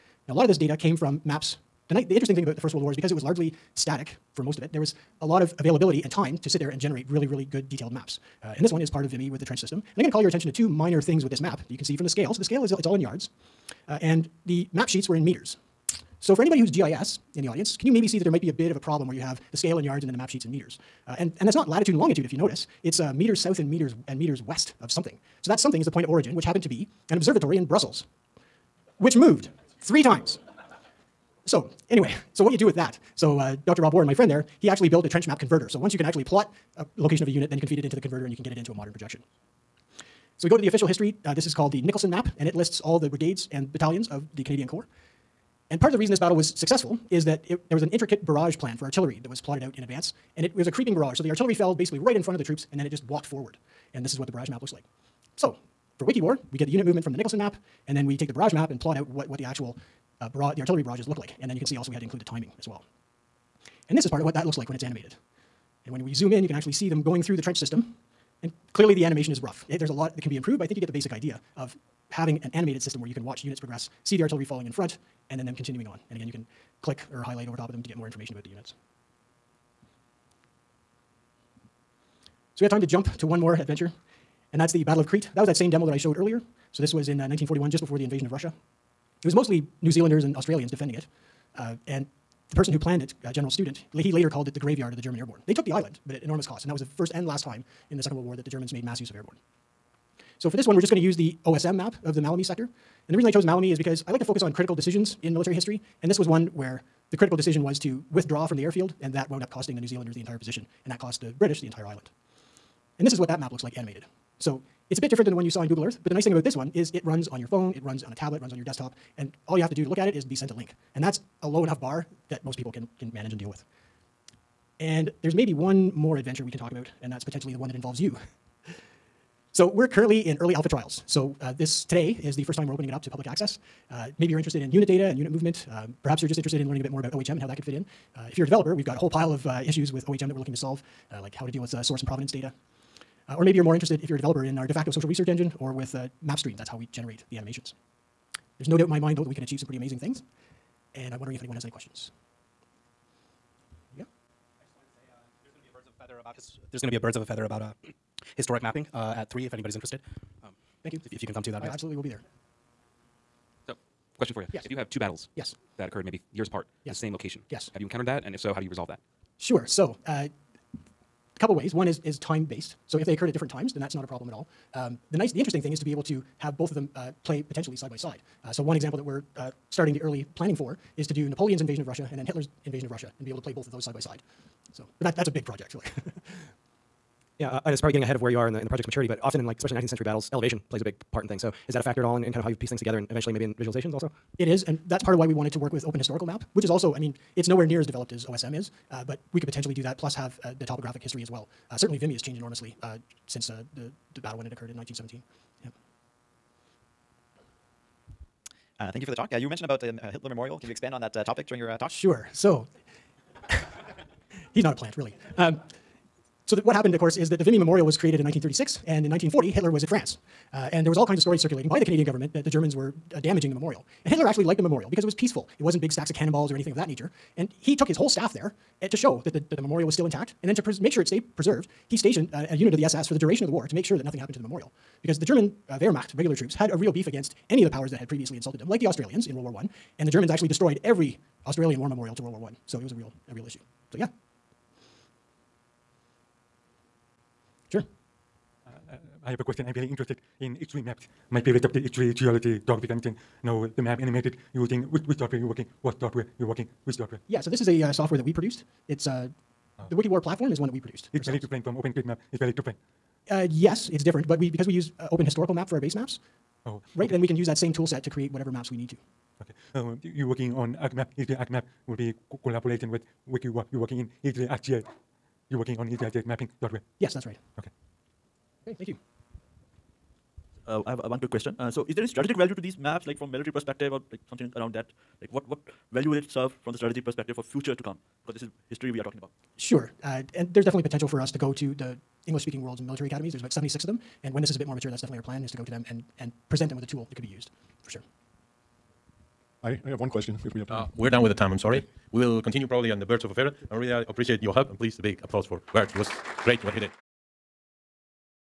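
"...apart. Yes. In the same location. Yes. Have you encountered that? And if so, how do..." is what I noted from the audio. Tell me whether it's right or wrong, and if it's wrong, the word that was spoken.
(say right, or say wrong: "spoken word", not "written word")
right.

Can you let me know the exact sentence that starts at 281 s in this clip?
Uh, so, is there any strategic value to these maps, like from military perspective or like something around that?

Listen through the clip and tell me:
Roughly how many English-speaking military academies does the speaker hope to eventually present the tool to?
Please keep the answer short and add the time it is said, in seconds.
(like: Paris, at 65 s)
76, at 293 s.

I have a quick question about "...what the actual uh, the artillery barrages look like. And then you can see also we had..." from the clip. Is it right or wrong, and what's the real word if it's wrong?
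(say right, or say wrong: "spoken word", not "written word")
right.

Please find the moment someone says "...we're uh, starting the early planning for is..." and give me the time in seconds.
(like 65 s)
179 s.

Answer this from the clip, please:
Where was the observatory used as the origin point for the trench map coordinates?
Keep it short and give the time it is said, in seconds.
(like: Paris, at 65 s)
Brussels, at 27 s.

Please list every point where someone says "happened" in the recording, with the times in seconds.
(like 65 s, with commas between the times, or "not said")
26 s, 216 s, 234 s.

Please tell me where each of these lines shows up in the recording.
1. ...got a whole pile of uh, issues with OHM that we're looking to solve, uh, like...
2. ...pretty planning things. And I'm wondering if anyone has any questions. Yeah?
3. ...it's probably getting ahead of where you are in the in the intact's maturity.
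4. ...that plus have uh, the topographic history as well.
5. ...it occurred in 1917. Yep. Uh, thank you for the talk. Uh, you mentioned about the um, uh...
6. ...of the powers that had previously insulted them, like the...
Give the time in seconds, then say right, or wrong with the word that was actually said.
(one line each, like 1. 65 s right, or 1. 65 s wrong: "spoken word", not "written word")
1. 138 s right
2. 149 s wrong: "amazing", not "planning"
3. 187 s wrong: "project", not "intact"
4. 199 s right
5. 204 s right
6. 237 s right.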